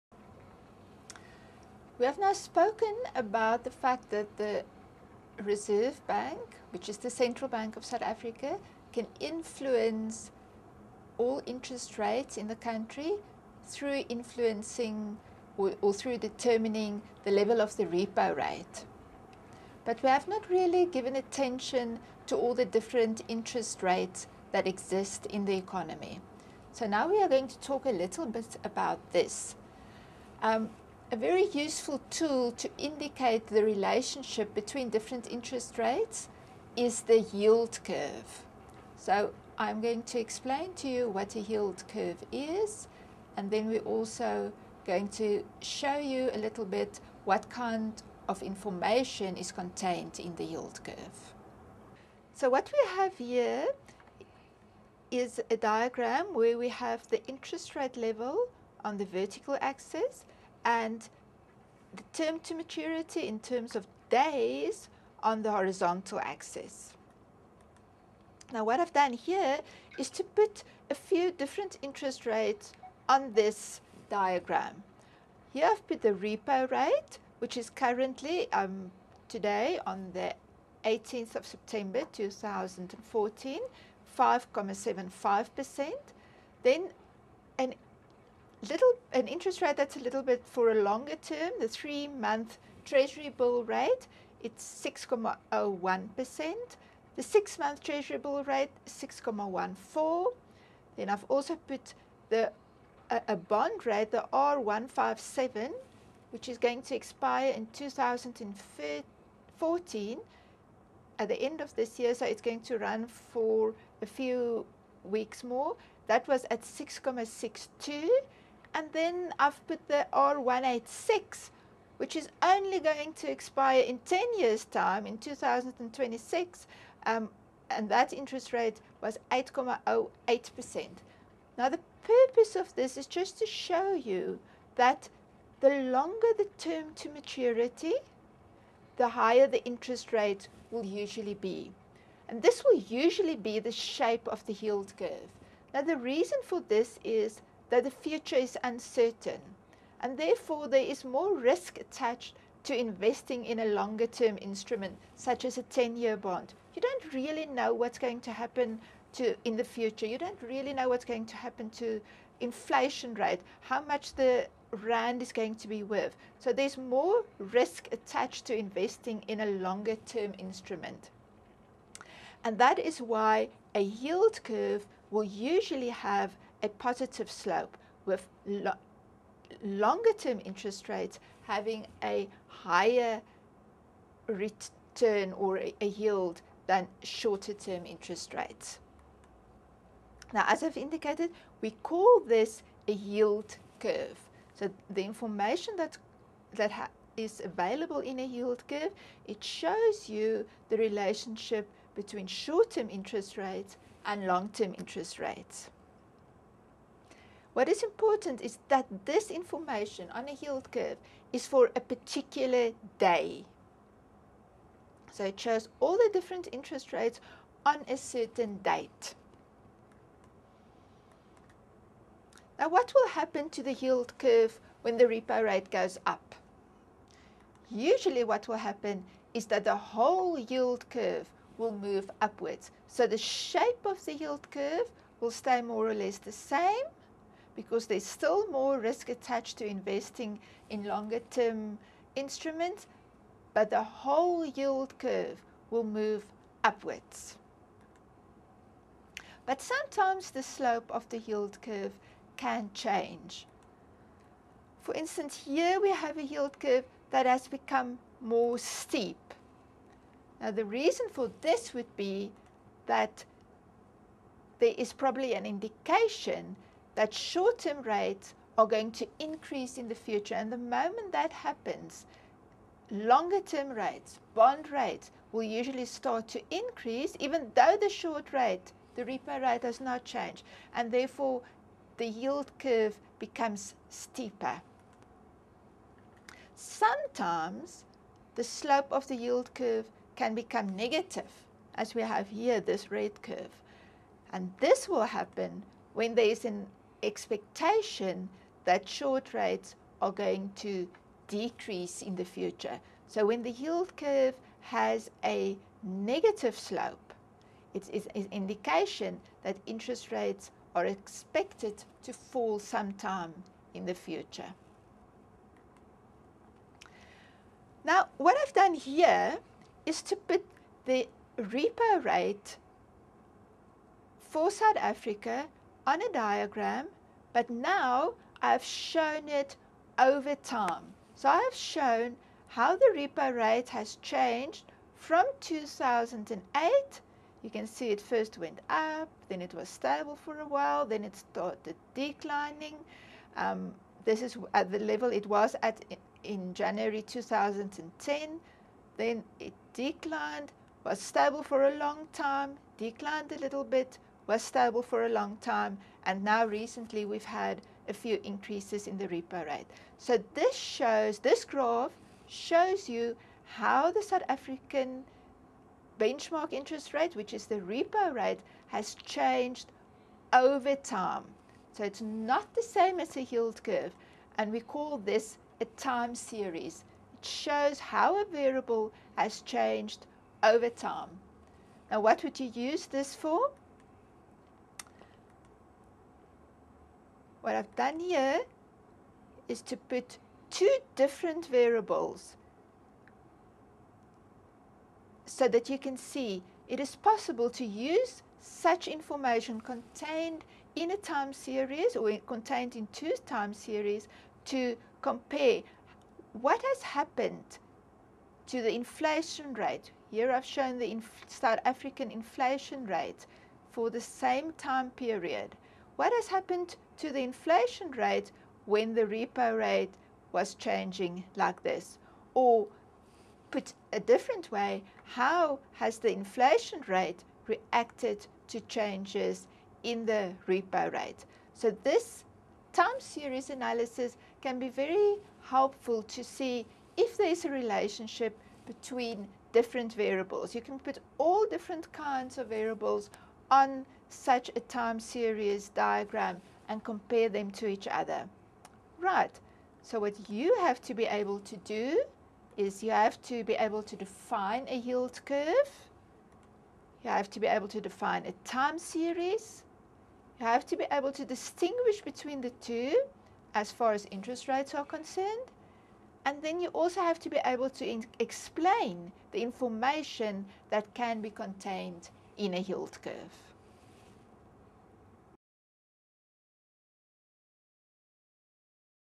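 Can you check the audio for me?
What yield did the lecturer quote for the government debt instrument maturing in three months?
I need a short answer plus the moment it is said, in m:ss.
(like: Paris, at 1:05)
6.01%, at 1:34.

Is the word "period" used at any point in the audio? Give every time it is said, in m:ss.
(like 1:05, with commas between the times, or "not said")
6:54.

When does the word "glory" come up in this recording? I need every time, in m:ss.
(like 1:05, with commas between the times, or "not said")
not said.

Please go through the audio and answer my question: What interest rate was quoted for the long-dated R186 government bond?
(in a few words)
8.08%.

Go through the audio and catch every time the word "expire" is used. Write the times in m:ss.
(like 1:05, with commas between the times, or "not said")
1:46, 2:03.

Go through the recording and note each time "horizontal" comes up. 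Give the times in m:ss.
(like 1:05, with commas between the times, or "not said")
1:05.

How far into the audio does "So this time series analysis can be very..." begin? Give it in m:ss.
7:11.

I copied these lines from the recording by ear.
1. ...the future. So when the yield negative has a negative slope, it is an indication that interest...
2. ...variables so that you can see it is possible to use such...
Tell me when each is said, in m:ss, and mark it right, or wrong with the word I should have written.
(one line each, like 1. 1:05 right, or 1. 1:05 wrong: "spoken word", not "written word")
1. 5:02 wrong: "curve", not "negative"
2. 6:31 right.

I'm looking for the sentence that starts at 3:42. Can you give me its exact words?
Now what will happen to the yield curve when the repo rate goes up?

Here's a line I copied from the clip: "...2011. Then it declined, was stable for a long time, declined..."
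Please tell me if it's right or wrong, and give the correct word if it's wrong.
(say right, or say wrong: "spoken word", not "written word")
wrong: "2010", not "2011".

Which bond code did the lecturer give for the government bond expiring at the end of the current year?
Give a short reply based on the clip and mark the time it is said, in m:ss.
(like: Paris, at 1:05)
R157, at 1:44.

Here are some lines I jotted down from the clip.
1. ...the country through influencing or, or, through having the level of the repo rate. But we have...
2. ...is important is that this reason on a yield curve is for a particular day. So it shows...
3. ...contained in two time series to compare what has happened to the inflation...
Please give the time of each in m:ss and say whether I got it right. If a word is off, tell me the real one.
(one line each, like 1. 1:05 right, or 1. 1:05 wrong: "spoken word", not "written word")
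1. 0:12 wrong: "determining", not "having"
2. 3:27 wrong: "information", not "reason"
3. 6:42 right.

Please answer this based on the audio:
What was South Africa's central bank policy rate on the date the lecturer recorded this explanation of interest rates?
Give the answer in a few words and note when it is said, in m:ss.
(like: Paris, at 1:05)
5.75%, at 1:24.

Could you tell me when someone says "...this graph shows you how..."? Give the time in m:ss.
6:01.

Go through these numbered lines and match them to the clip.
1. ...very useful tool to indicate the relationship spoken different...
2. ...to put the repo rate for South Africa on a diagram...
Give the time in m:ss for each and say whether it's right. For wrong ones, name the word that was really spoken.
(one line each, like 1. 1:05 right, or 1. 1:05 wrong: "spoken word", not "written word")
1. 0:31 wrong: "between", not "spoken"
2. 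5:20 right.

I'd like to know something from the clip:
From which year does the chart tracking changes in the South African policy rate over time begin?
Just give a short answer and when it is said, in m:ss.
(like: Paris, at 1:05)
2008, at 5:35.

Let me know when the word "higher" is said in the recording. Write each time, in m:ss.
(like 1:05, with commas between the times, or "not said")
2:19, 3:02.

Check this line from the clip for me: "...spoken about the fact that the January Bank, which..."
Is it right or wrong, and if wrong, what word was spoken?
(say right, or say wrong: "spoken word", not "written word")
wrong: "Reserve", not "January".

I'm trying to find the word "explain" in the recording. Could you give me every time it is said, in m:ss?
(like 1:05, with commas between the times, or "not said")
0:40, 7:48.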